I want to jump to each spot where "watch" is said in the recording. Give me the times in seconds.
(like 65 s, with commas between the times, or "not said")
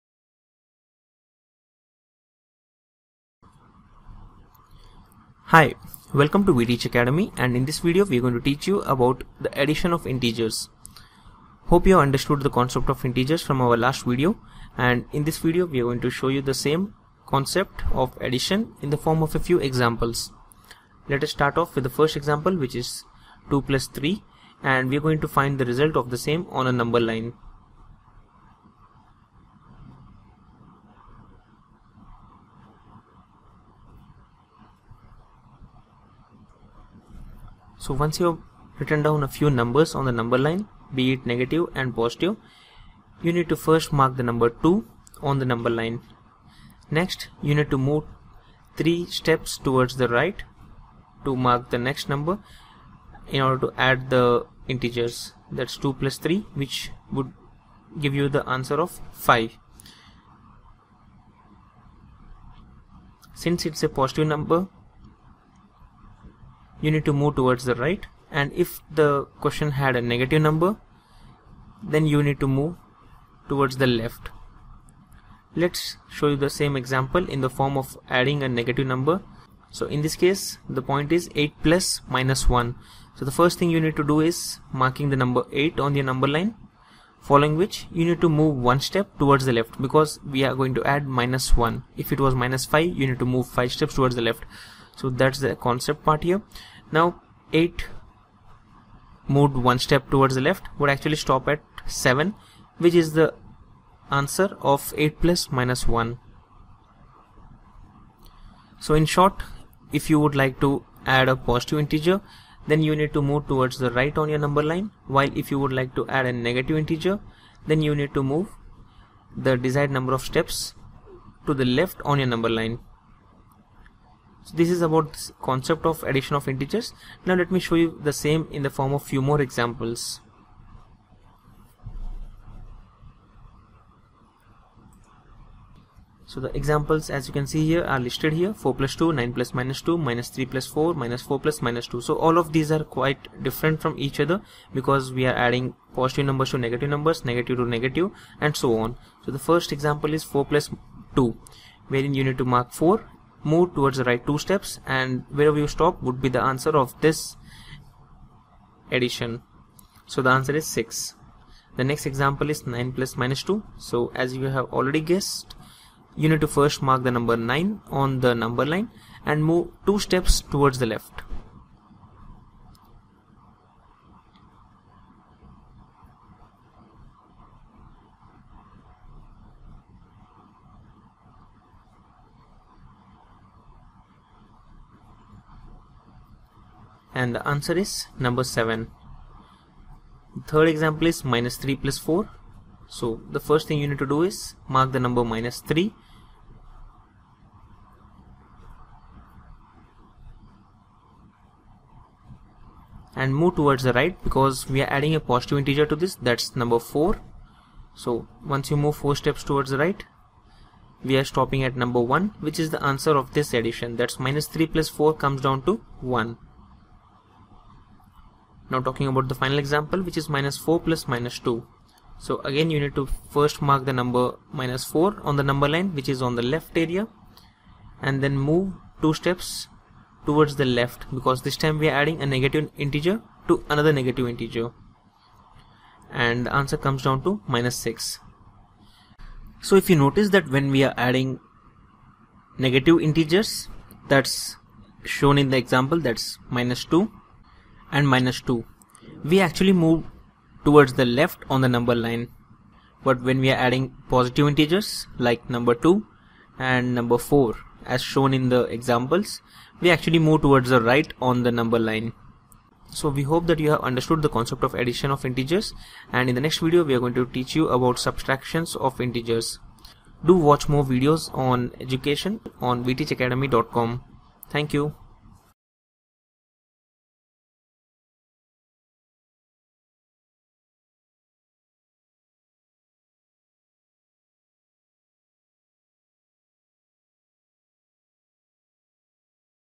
270 s.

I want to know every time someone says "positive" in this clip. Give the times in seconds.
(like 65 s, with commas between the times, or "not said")
41 s, 64 s, 111 s, 145 s, 205 s, 254 s.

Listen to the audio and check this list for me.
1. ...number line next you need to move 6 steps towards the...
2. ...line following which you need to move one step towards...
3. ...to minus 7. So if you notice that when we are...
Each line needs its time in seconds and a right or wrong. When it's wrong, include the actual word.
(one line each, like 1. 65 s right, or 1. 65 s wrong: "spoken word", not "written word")
1. 45 s wrong: "3", not "6"
2. 86 s right
3. 237 s wrong: "6", not "7".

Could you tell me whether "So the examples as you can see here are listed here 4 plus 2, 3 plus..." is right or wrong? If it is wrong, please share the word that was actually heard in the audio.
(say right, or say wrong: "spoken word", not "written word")
wrong: "9", not "3".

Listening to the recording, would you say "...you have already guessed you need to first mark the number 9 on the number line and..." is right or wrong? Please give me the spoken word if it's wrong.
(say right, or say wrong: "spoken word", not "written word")
right.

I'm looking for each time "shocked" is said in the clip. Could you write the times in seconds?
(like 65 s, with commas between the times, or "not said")
not said.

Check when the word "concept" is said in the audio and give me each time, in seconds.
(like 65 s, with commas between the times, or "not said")
12 s, 17 s, 95 s, 125 s, 264 s.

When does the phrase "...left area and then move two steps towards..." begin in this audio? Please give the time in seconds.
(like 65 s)
226 s.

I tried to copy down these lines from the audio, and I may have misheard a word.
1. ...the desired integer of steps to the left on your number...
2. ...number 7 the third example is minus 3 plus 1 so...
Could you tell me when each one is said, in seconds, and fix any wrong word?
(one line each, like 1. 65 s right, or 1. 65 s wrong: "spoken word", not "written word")
1. 119 s wrong: "number", not "integer"
2. 188 s wrong: "4", not "1".